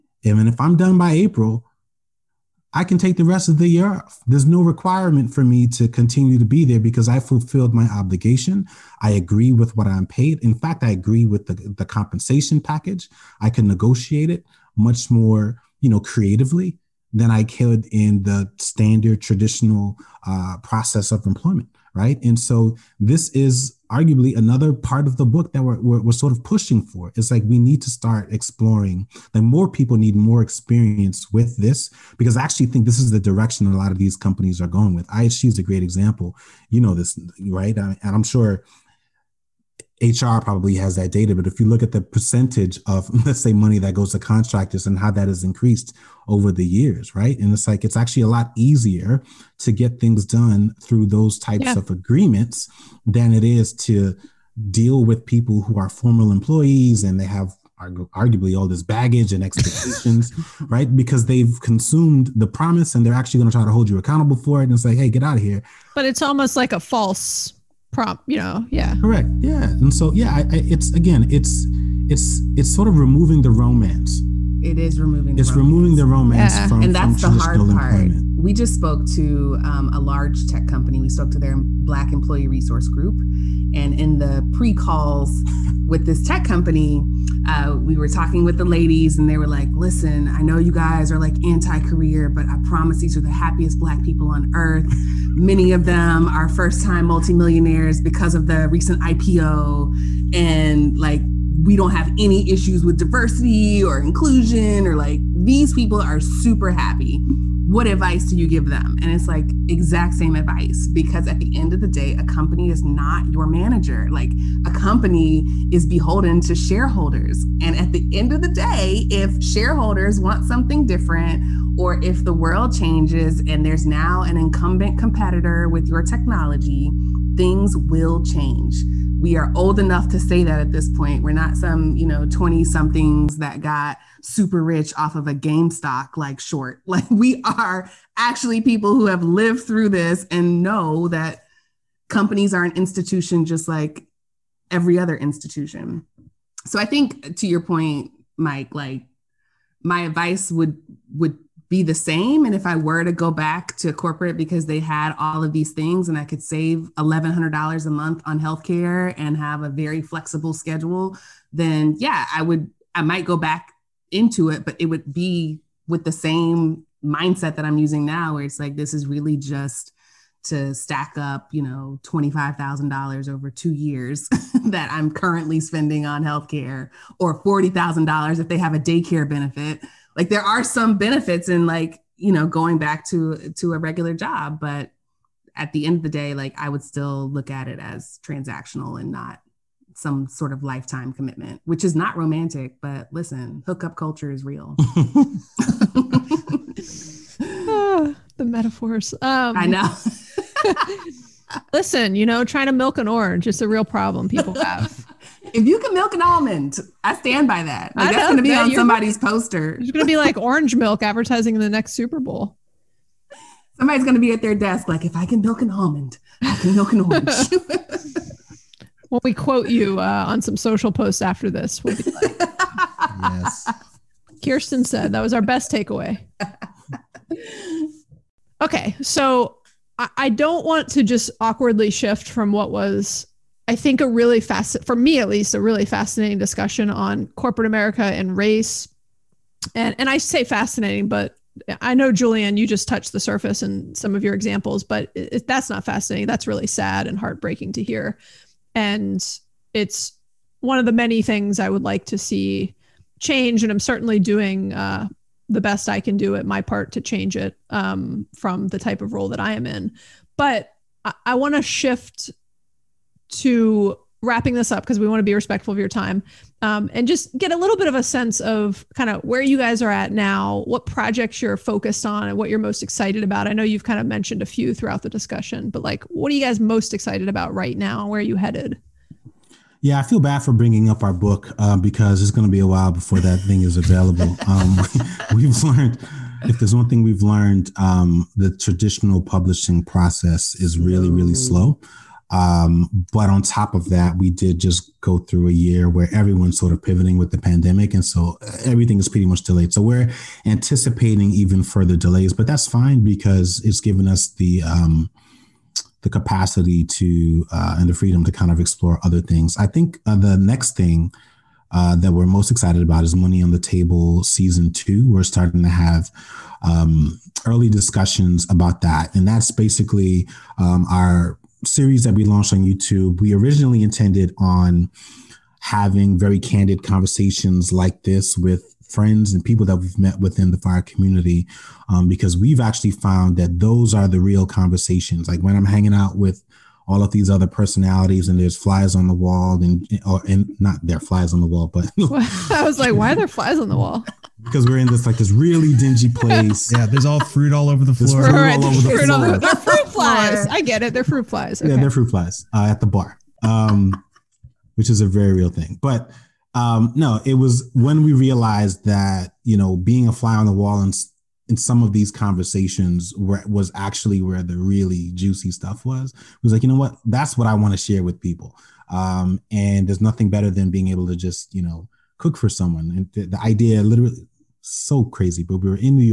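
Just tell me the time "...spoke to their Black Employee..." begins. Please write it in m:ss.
1:21.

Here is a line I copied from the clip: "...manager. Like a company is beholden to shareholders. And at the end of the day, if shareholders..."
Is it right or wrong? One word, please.
right.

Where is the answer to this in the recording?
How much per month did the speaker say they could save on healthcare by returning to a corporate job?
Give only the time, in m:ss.
2:36.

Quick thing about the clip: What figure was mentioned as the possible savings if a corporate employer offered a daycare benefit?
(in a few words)
$40,000.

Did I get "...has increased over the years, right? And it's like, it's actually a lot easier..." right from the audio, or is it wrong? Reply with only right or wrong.
right.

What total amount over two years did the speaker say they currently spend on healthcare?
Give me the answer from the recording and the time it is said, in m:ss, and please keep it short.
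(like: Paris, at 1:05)
$25,000, at 2:52.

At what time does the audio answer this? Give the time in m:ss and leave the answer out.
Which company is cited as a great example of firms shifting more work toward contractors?
0:35.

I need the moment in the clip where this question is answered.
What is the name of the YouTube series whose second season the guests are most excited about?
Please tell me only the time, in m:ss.
5:13.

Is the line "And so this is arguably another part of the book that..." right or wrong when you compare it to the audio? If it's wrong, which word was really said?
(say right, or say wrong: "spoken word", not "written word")
right.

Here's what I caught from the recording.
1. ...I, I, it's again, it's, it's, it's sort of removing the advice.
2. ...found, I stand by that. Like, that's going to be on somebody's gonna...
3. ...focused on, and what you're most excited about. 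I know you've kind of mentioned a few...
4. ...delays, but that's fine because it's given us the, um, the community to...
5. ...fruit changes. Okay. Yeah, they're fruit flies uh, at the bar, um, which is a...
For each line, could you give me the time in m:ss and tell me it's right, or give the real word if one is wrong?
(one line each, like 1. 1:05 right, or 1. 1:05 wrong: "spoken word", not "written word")
1. 1:10 wrong: "romance", not "advice"
2. 3:26 wrong: "almond", not "found"
3. 4:31 right
4. 5:01 wrong: "capacity", not "community"
5. 5:51 wrong: "flies", not "changes".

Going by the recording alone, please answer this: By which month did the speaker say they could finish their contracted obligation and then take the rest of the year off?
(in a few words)
April.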